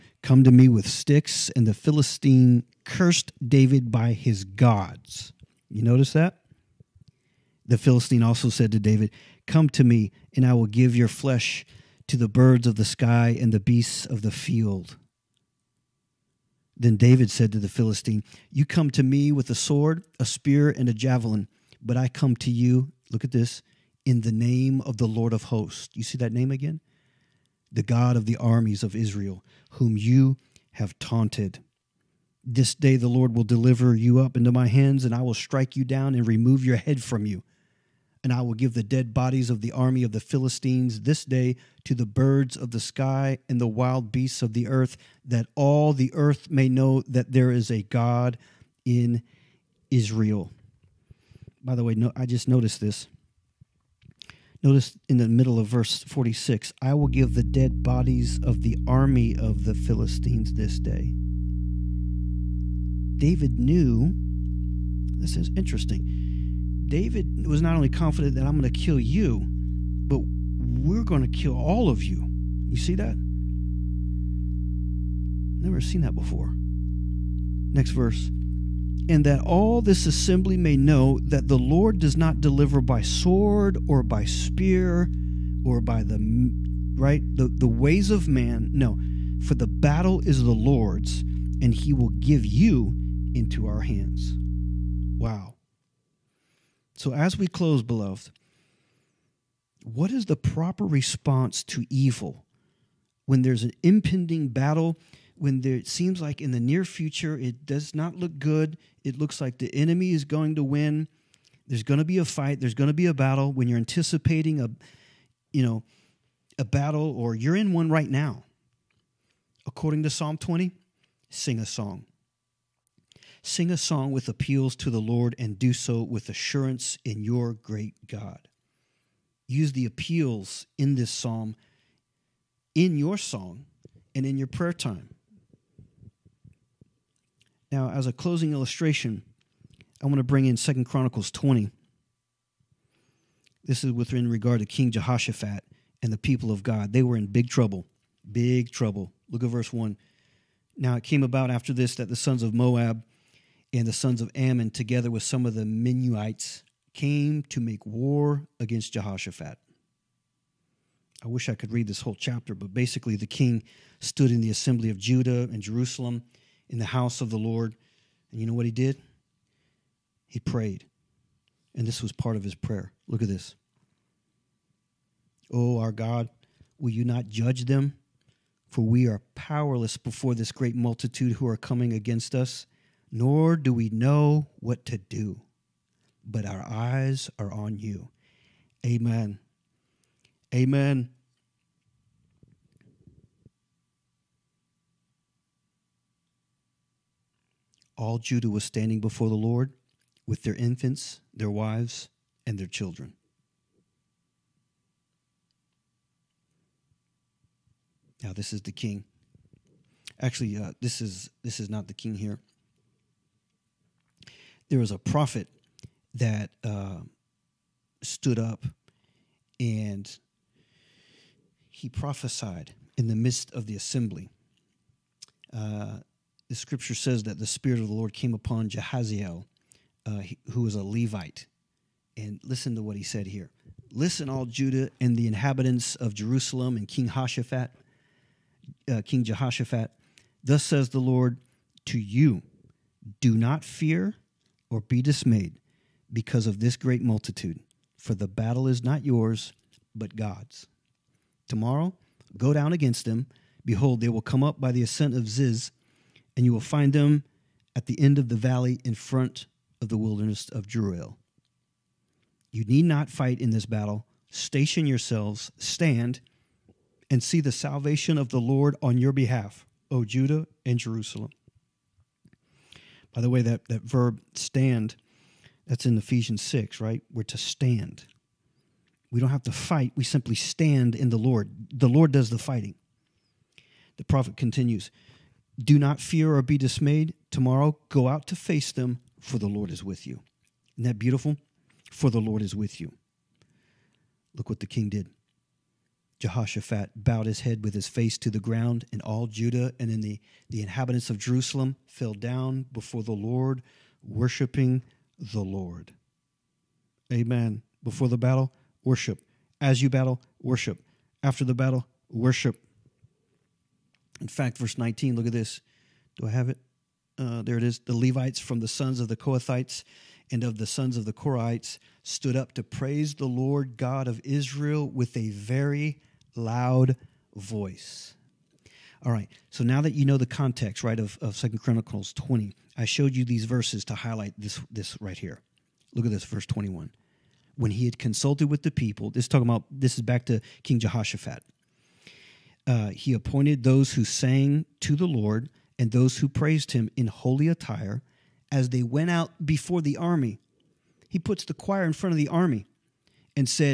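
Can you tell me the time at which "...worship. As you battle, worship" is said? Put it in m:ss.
5:08.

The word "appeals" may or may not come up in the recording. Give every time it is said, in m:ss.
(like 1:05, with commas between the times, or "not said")
2:04, 2:09.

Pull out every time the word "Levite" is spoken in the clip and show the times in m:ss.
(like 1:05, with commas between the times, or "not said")
3:50, 5:17.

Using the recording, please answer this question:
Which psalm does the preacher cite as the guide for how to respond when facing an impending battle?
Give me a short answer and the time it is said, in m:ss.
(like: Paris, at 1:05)
Psalm 20, at 2:00.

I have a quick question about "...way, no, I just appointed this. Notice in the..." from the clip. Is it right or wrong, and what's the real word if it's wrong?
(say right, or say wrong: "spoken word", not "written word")
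wrong: "noticed", not "appointed".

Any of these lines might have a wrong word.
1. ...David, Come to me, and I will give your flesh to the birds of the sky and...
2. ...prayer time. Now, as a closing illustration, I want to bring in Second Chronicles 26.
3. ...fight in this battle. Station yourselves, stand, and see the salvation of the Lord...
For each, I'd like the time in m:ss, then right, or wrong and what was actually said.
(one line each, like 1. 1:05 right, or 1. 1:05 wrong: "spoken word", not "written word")
1. 0:08 right
2. 2:14 wrong: "20", not "26"
3. 4:23 right.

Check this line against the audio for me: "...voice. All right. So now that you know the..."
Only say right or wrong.
right.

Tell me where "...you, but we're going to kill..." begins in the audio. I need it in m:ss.
1:08.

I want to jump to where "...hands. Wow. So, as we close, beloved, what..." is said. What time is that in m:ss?
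1:33.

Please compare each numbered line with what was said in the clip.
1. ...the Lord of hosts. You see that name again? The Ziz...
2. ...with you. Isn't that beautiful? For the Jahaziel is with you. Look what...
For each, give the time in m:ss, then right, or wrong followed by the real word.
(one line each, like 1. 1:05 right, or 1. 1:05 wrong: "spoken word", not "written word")
1. 0:24 wrong: "God", not "Ziz"
2. 4:49 wrong: "Lord", not "Jahaziel".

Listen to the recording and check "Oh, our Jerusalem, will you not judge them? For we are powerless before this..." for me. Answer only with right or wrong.
wrong.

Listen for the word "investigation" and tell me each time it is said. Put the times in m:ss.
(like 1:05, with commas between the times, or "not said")
not said.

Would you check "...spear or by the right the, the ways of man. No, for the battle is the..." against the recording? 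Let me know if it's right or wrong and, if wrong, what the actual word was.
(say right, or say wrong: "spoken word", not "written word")
right.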